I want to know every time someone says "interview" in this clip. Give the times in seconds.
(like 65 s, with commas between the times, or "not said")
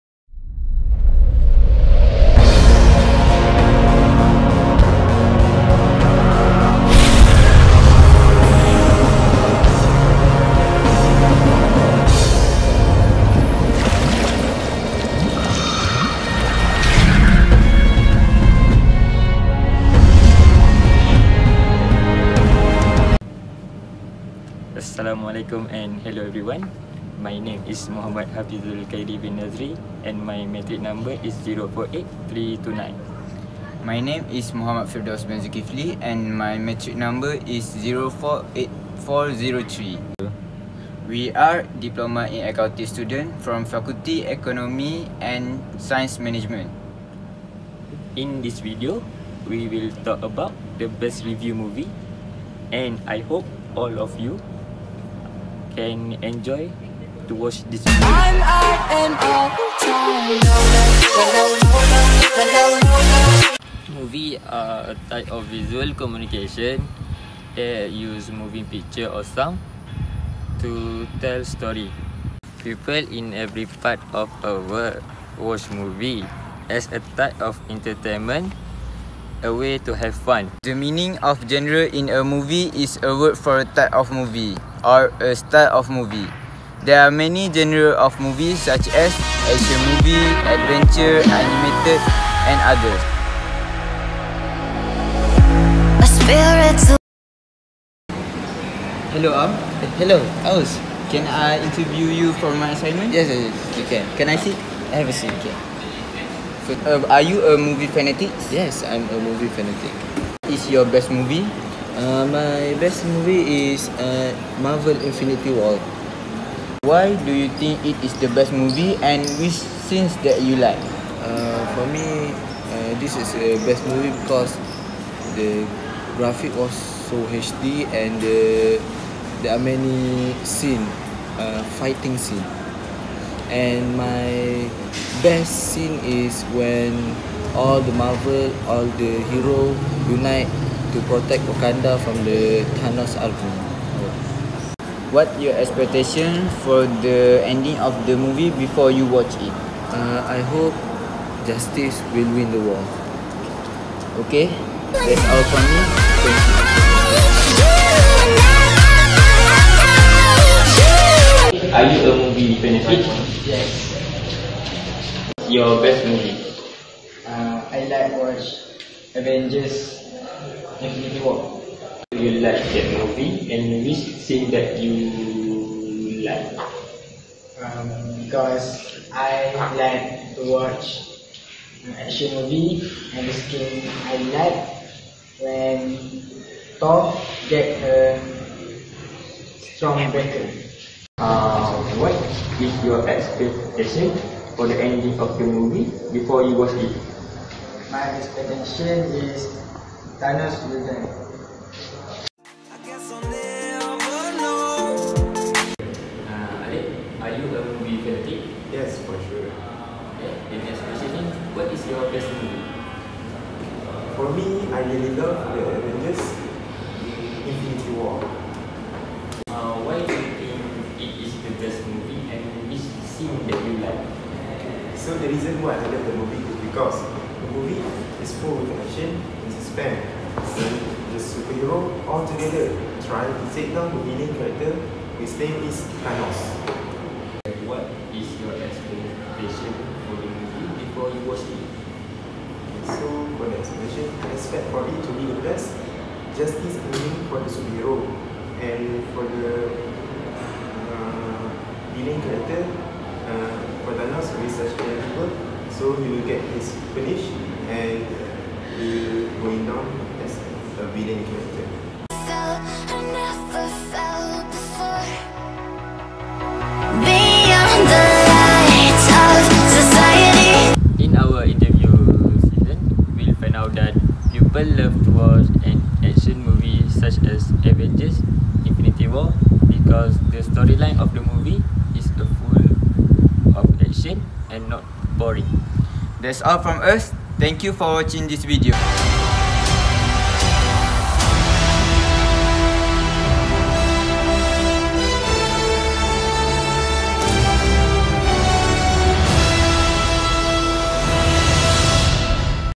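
101 s, 271 s.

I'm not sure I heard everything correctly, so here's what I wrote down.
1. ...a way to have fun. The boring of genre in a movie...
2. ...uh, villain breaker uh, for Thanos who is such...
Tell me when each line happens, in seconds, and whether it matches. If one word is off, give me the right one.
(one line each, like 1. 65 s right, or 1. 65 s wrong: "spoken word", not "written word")
1. 79 s wrong: "meaning", not "boring"
2. 250 s wrong: "character", not "breaker".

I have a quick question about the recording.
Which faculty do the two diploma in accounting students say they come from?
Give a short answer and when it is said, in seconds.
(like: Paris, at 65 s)
Faculty Economy and Science Management, at 43 s.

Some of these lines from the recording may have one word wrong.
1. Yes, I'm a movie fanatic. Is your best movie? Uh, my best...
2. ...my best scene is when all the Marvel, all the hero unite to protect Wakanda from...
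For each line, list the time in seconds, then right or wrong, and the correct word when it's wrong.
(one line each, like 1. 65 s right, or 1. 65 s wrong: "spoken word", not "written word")
1. 108 s right
2. 133 s right.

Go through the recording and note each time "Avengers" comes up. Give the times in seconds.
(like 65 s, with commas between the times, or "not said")
169 s, 215 s, 277 s.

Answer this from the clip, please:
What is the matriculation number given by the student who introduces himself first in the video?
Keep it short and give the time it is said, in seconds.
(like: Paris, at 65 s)
048329, at 31 s.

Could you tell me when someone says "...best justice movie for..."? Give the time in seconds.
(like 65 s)
245 s.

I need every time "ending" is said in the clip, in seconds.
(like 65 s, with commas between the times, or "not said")
147 s, 194 s.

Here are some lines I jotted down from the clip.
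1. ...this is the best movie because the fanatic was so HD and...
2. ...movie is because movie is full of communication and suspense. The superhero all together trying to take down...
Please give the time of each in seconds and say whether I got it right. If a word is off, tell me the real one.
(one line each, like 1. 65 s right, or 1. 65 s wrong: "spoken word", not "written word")
1. 123 s wrong: "graphic", not "fanatic"
2. 226 s wrong: "action", not "communication".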